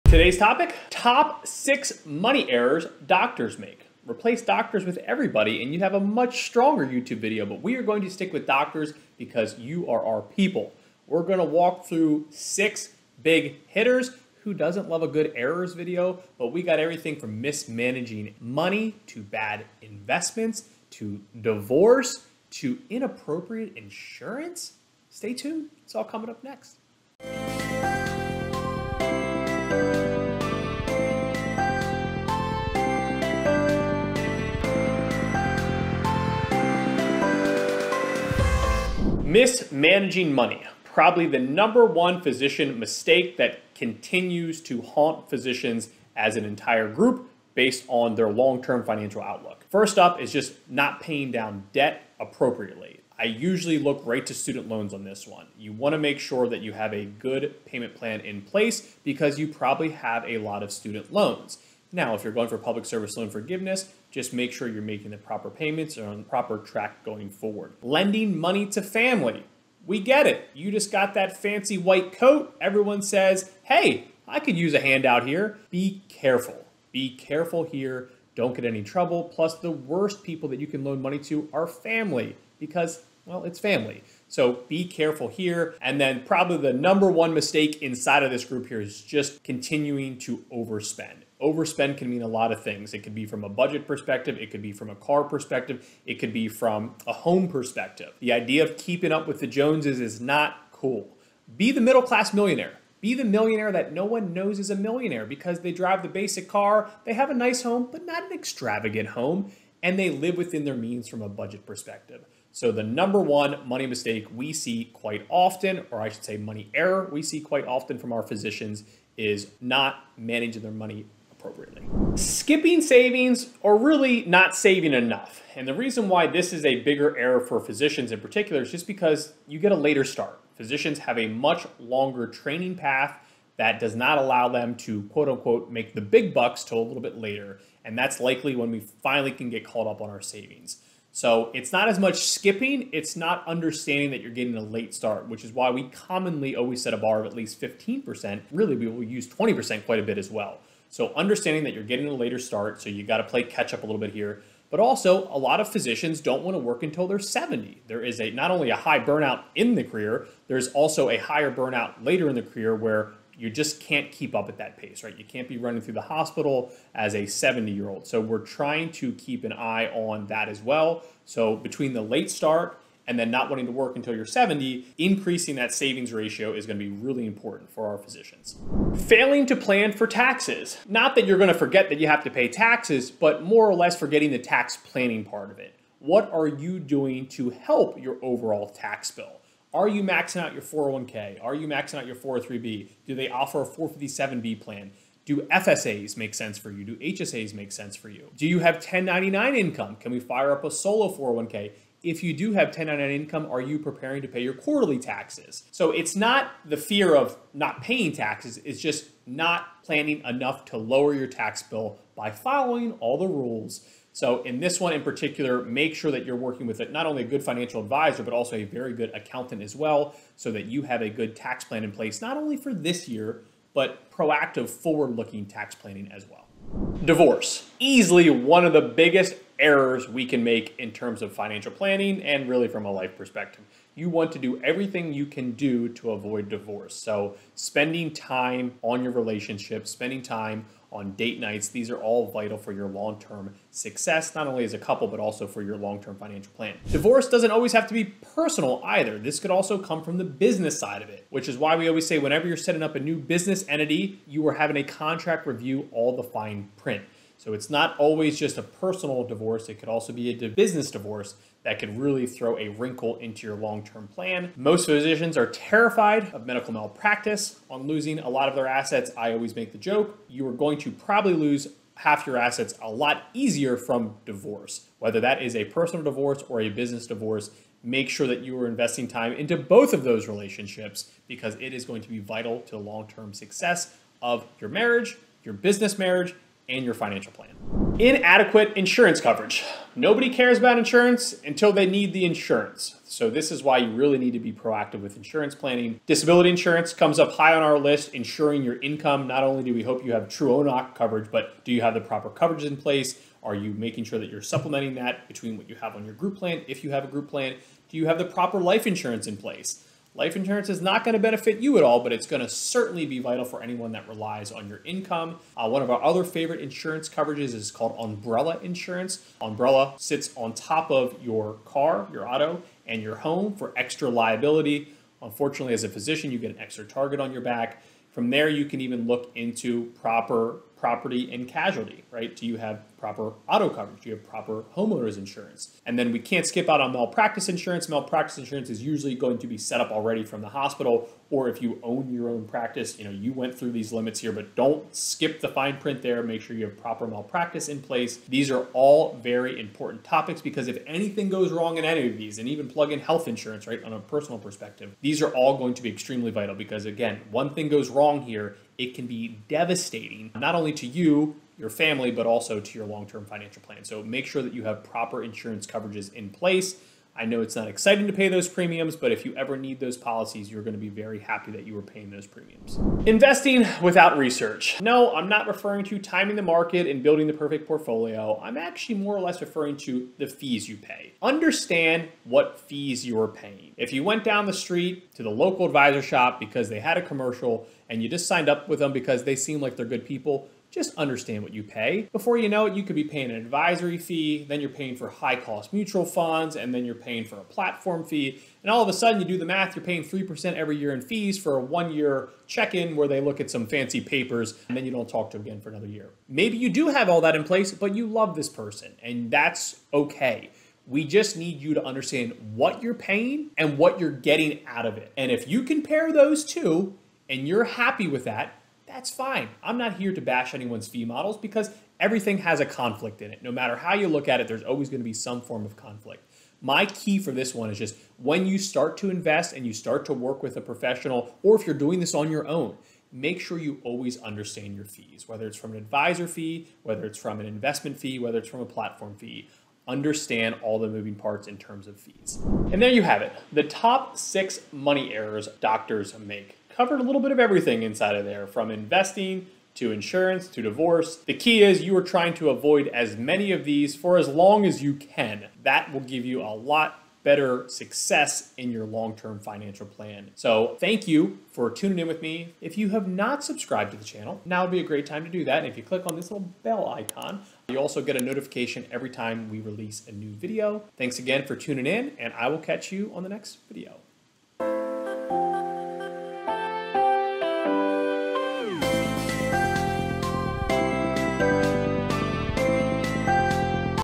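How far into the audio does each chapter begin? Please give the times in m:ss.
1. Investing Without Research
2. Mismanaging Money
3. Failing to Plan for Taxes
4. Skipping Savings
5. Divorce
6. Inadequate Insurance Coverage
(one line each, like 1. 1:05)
1. 6:13
2. 0:39
3. 2:59
4. 2:02
5. 3:47
6. 4:48.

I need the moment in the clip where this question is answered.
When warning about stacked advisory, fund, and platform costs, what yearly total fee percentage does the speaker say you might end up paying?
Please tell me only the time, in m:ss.
6:40.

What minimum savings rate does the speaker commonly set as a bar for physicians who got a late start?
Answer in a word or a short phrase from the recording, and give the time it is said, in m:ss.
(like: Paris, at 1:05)
15%, at 2:27.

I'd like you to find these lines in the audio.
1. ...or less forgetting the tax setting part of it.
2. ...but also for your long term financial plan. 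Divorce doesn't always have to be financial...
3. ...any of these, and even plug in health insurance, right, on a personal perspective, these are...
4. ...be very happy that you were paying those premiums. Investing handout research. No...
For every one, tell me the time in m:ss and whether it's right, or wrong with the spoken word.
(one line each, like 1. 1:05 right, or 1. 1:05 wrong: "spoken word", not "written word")
1. 3:03 wrong: "planning", not "setting"
2. 4:05 wrong: "personal", not "financial"
3. 5:51 right
4. 6:10 wrong: "without", not "handout".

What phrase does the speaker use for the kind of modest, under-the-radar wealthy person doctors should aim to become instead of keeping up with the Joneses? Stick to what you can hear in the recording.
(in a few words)
Middle class millionaire.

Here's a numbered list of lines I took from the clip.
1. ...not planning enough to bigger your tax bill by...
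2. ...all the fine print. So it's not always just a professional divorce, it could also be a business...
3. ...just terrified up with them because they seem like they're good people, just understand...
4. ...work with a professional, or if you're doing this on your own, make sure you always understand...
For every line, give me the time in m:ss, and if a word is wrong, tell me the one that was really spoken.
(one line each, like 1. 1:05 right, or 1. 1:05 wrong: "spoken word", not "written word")
1. 3:29 wrong: "lower", not "bigger"
2. 4:15 wrong: "personal", not "professional"
3. 6:28 wrong: "signed", not "terrified"
4. 7:10 right.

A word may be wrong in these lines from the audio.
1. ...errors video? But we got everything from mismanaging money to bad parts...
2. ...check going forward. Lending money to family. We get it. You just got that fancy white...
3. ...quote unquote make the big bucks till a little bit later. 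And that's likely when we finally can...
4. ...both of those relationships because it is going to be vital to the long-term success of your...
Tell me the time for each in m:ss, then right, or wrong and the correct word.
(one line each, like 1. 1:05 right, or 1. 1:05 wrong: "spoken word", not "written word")
1. 0:15 wrong: "investments", not "parts"
2. 1:06 wrong: "track", not "check"
3. 2:15 right
4. 4:39 right.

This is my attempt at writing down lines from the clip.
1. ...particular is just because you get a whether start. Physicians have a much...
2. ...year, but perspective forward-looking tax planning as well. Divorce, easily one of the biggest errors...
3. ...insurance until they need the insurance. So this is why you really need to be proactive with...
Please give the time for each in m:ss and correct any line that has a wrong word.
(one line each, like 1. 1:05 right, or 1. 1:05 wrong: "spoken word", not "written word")
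1. 2:08 wrong: "later", not "whether"
2. 3:43 wrong: "proactive", not "perspective"
3. 4:50 right.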